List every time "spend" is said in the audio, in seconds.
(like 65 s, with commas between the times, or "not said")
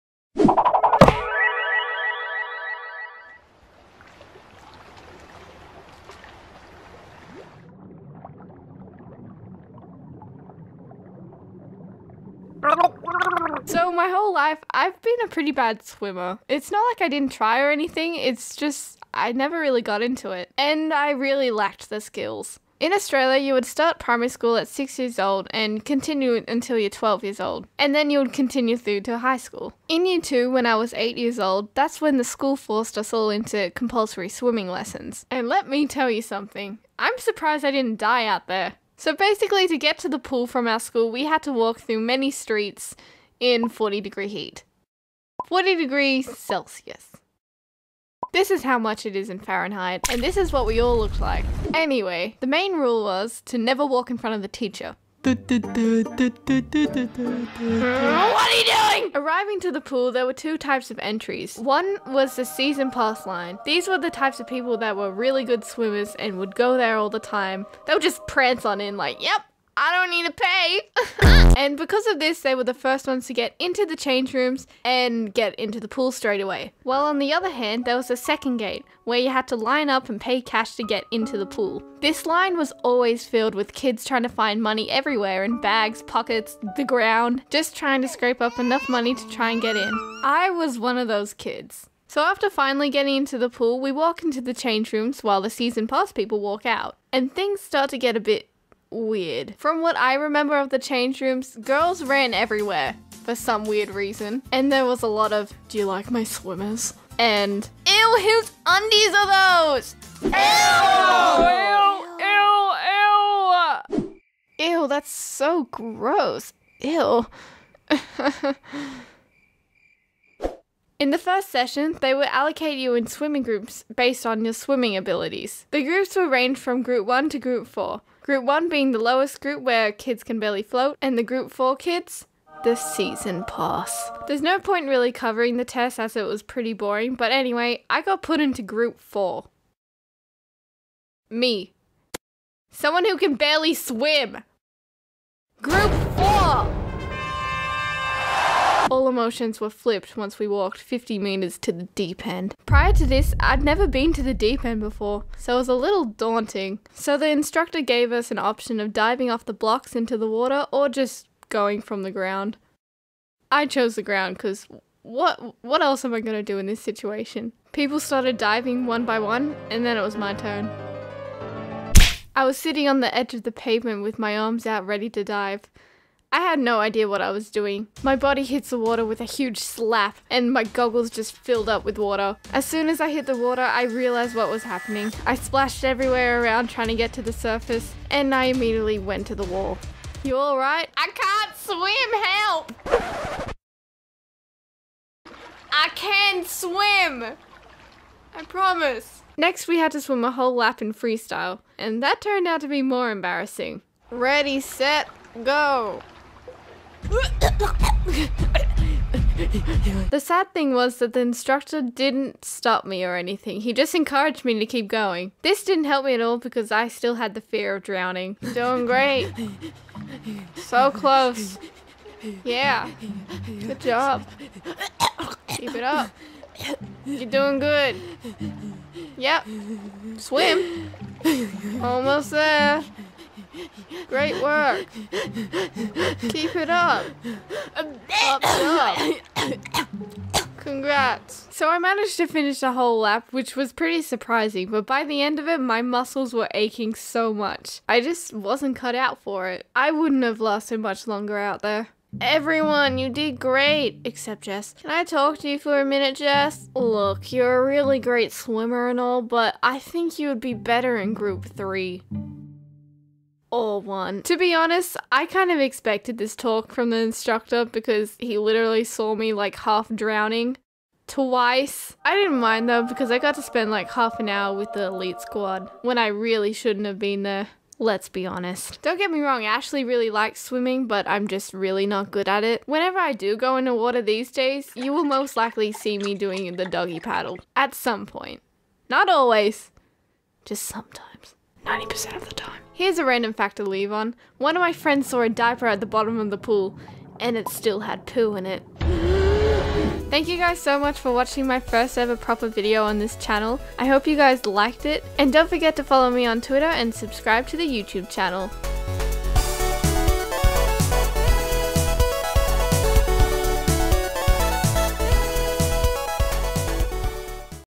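273 s.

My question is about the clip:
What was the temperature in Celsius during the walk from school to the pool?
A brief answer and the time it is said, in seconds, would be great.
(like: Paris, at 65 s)
40 degrees, at 45 s.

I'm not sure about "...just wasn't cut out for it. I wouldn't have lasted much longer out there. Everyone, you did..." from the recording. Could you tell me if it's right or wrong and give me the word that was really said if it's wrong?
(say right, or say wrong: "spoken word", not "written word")
right.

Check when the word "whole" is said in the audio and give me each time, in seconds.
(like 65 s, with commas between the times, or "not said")
14 s, 200 s, 242 s.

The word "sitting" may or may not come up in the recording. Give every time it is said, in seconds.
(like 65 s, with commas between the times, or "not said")
172 s.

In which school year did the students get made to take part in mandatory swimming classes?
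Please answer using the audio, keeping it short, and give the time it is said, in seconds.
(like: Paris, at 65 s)
Year 2, at 30 s.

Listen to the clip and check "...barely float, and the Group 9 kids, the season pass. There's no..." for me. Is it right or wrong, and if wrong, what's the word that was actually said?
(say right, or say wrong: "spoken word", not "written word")
wrong: "4", not "9".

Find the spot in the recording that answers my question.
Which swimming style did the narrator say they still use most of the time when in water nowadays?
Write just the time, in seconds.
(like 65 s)
286 s.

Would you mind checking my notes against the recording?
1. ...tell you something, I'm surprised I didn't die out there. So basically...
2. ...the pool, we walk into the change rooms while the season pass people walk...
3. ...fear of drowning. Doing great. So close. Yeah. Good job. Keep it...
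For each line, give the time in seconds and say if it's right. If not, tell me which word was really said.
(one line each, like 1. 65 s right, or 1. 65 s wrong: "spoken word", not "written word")
1. 35 s right
2. 93 s right
3. 217 s right.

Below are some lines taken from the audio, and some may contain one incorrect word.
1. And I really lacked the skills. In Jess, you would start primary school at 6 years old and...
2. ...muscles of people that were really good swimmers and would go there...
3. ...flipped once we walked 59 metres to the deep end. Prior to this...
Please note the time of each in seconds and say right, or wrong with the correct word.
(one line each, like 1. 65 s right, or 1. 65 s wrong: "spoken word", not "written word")
1. 20 s wrong: "Australia", not "Jess"
2. 64 s wrong: "types", not "muscles"
3. 149 s wrong: "50", not "59".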